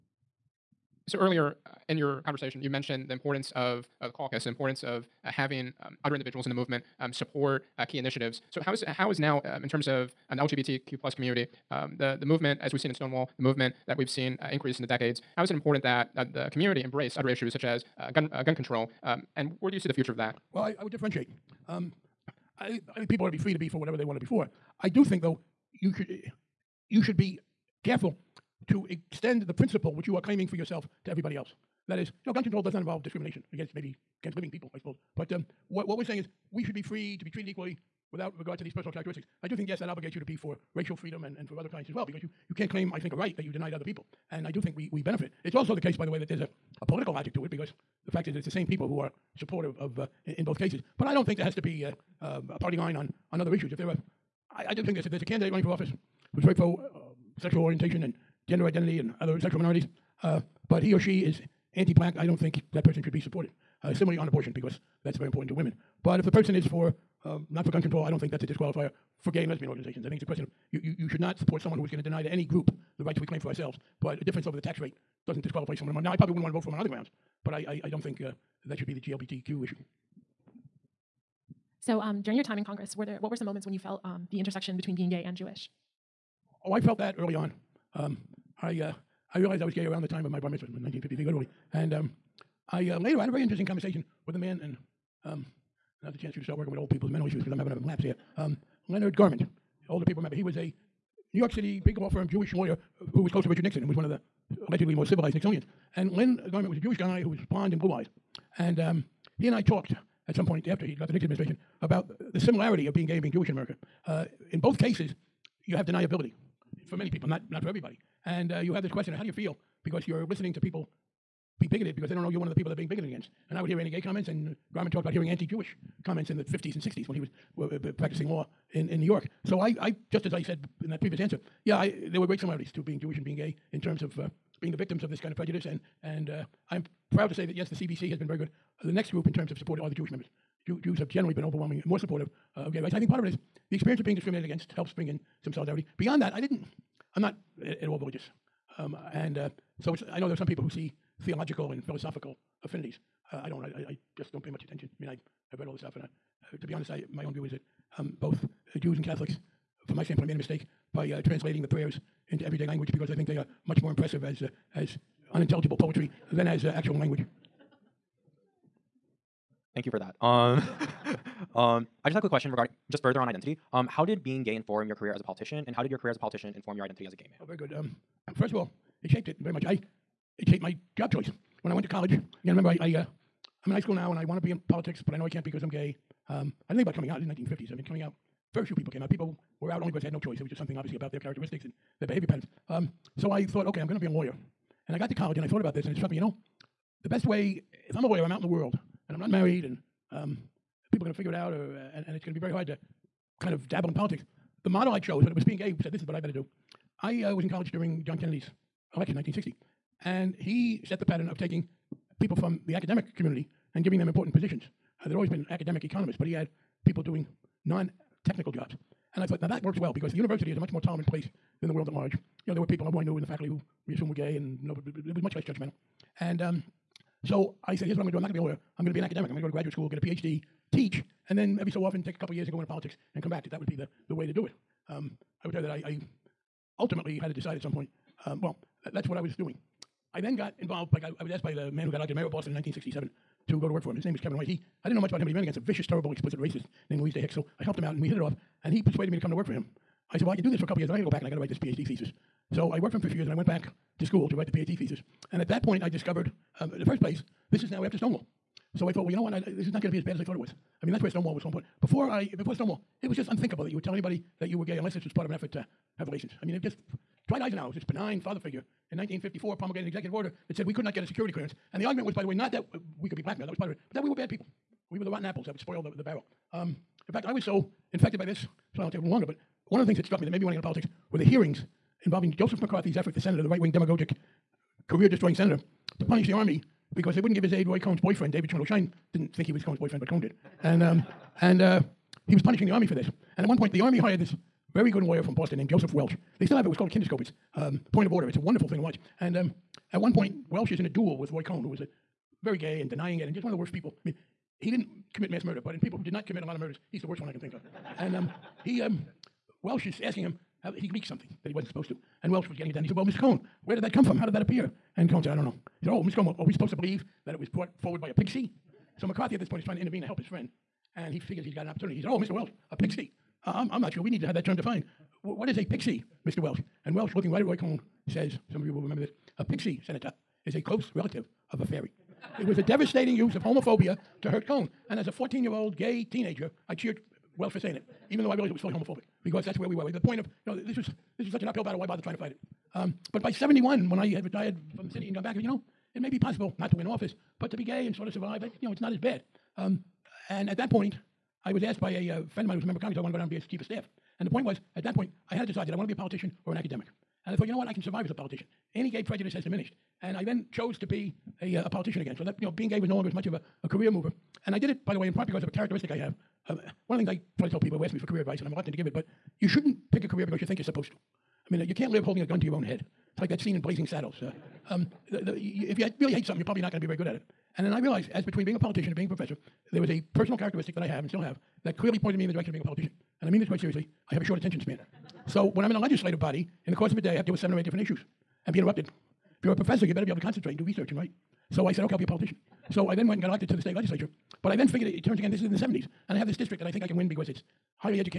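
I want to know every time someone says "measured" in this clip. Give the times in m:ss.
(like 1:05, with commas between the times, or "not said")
not said.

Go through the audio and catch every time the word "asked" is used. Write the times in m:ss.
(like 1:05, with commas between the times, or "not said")
4:01, 5:51.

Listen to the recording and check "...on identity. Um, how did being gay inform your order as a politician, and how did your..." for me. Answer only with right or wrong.
wrong.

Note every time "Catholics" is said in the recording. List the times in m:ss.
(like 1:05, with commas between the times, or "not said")
2:39.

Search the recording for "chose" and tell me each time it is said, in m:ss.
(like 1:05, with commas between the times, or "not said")
3:24, 6:00.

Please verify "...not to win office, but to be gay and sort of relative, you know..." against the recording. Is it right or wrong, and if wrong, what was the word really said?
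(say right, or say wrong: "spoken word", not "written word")
wrong: "survive", not "relative".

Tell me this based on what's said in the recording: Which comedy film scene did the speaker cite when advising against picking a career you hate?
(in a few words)
Blazing Saddles.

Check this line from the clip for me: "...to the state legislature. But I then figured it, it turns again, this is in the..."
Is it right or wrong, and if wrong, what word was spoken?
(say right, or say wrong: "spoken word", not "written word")
right.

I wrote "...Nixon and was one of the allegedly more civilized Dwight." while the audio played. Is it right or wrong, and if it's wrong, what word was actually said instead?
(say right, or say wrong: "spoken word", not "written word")
wrong: "Nixonians", not "Dwight".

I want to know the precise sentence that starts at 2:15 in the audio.
And, and uh, I am proud to say that, yes, the CBC has been very good.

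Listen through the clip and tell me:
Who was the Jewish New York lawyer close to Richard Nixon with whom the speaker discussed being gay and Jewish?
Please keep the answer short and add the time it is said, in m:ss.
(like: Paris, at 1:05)
Leonard Garment, at 1:38.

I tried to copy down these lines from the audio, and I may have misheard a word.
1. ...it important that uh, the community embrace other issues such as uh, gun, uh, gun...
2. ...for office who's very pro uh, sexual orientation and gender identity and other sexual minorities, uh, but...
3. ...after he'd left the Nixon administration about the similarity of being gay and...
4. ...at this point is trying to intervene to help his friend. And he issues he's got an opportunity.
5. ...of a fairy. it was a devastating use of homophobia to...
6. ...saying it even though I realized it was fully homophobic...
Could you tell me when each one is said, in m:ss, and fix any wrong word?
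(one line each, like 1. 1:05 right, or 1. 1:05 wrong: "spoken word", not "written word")
1. 0:15 right
2. 0:55 right
3. 1:50 right
4. 5:19 wrong: "figures", not "issues"
5. 5:31 right
6. 5:37 right.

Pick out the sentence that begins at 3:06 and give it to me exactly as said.
Um, I didn't think about coming out.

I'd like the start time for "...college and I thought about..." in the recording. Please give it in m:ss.
3:15.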